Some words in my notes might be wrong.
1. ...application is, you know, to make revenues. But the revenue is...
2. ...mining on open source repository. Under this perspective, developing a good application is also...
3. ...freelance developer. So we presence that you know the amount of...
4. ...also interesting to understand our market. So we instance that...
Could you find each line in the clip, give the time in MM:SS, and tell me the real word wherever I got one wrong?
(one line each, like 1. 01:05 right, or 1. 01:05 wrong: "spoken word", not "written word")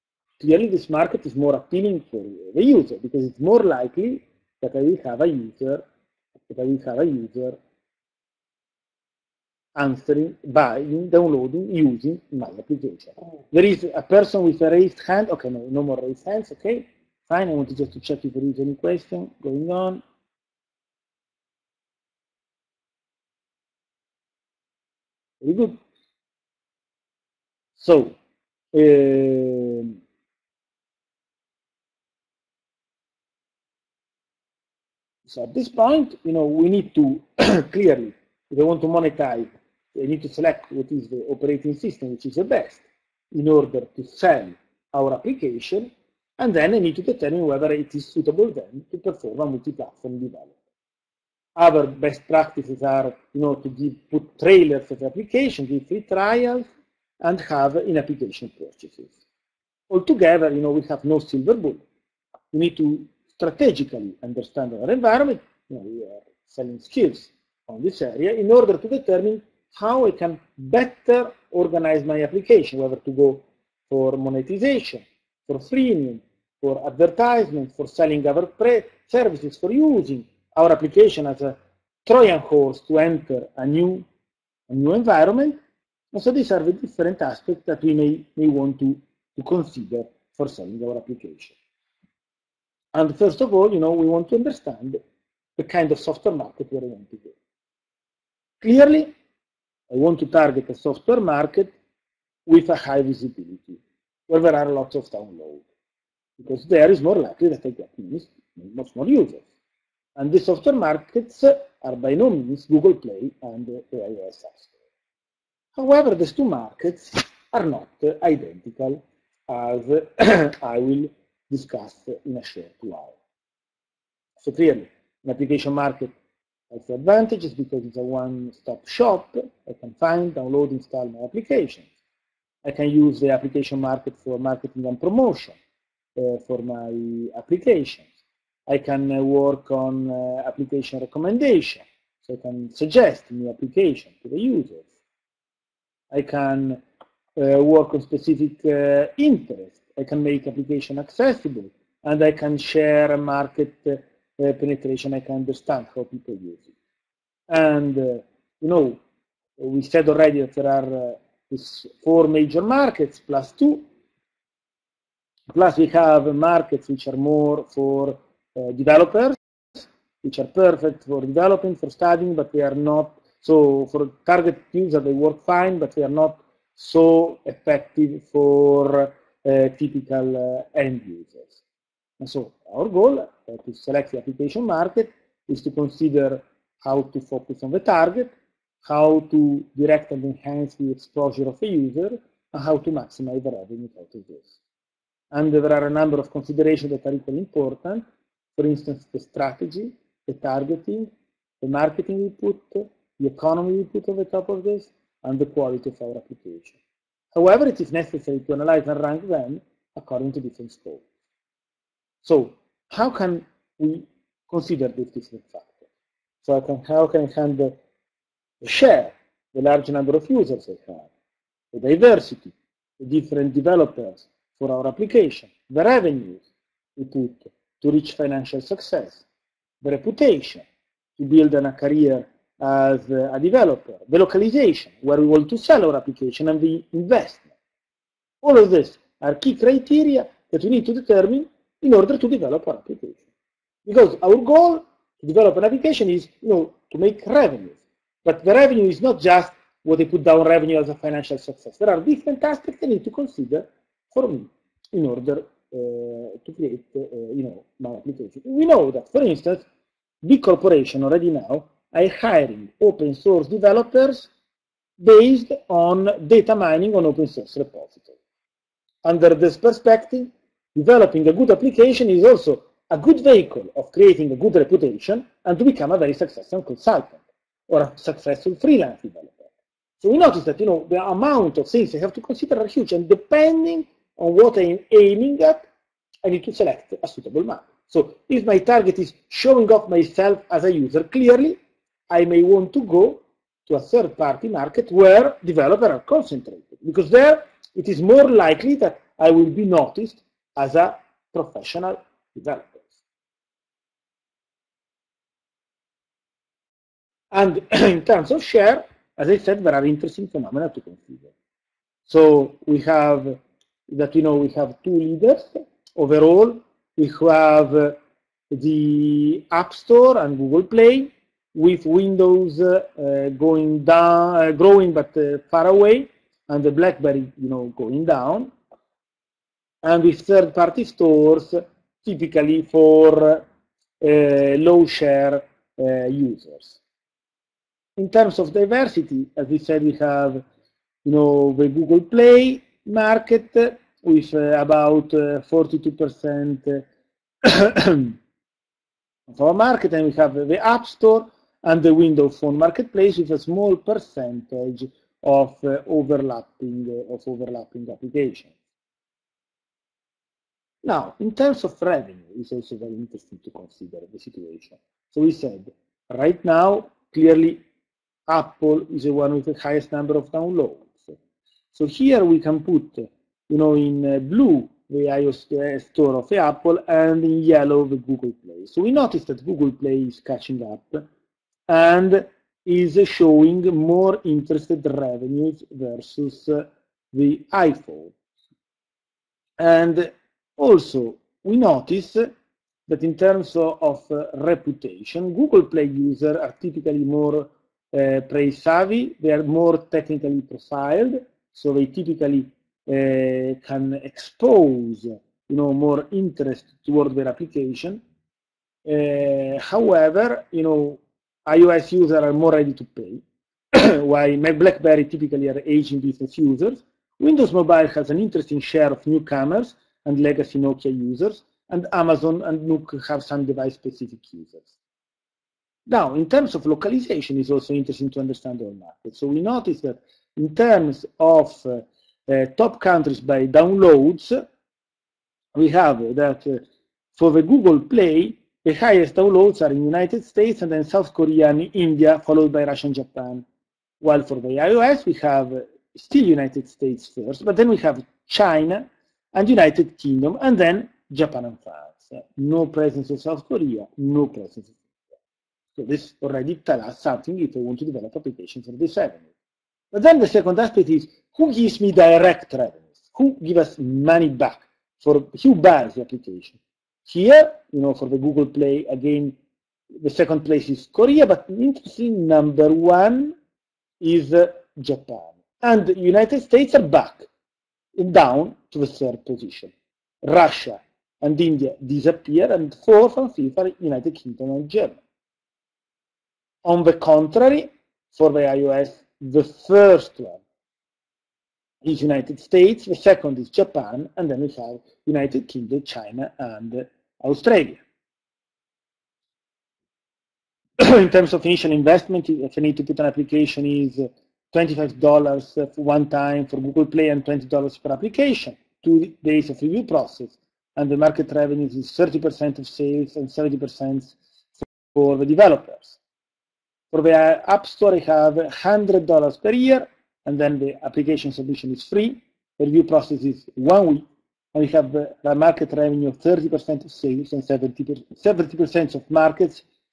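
1. 04:05 right
2. 04:26 right
3. 04:38 wrong: "notice", not "presence"
4. 07:07 wrong: "notice", not "instance".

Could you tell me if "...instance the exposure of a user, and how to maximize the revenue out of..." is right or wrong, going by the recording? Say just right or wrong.
wrong.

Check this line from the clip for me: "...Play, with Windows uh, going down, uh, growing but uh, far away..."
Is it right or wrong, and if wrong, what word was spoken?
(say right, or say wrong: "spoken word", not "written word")
right.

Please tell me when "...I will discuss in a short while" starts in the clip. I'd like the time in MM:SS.
02:00.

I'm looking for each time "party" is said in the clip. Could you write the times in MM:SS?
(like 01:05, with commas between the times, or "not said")
04:53, 05:30.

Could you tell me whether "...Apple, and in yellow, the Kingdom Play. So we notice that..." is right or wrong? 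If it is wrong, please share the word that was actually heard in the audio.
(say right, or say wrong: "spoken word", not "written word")
wrong: "Google", not "Kingdom".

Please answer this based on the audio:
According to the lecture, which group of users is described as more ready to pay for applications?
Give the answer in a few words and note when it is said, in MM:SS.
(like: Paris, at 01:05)
iOS users, at 06:51.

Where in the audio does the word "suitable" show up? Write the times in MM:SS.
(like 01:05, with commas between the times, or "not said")
00:48, 04:47.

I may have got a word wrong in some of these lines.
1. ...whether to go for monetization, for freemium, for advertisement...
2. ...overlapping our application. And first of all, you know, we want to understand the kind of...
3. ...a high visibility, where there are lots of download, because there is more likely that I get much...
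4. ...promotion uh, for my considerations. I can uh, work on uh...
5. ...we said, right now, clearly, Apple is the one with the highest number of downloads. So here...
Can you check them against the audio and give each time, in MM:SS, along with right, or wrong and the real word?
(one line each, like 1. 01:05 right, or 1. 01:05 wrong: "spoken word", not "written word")
1. 01:12 right
2. 01:30 wrong: "selling", not "overlapping"
3. 01:42 right
4. 02:15 wrong: "applications", not "considerations"
5. 06:05 right.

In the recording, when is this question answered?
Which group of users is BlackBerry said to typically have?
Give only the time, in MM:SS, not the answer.
06:55.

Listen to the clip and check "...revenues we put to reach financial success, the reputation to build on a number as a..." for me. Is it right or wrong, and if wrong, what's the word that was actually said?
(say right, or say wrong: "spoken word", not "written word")
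wrong: "career", not "number".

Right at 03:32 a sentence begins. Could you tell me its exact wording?
So how can we consider this different factor?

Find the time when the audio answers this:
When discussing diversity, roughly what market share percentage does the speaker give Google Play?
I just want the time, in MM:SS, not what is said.
05:45.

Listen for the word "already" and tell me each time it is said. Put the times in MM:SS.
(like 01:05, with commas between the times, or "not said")
02:40, 04:21, 07:36.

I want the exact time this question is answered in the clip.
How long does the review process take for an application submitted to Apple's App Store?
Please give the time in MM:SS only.
08:43.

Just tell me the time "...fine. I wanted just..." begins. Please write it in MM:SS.
00:17.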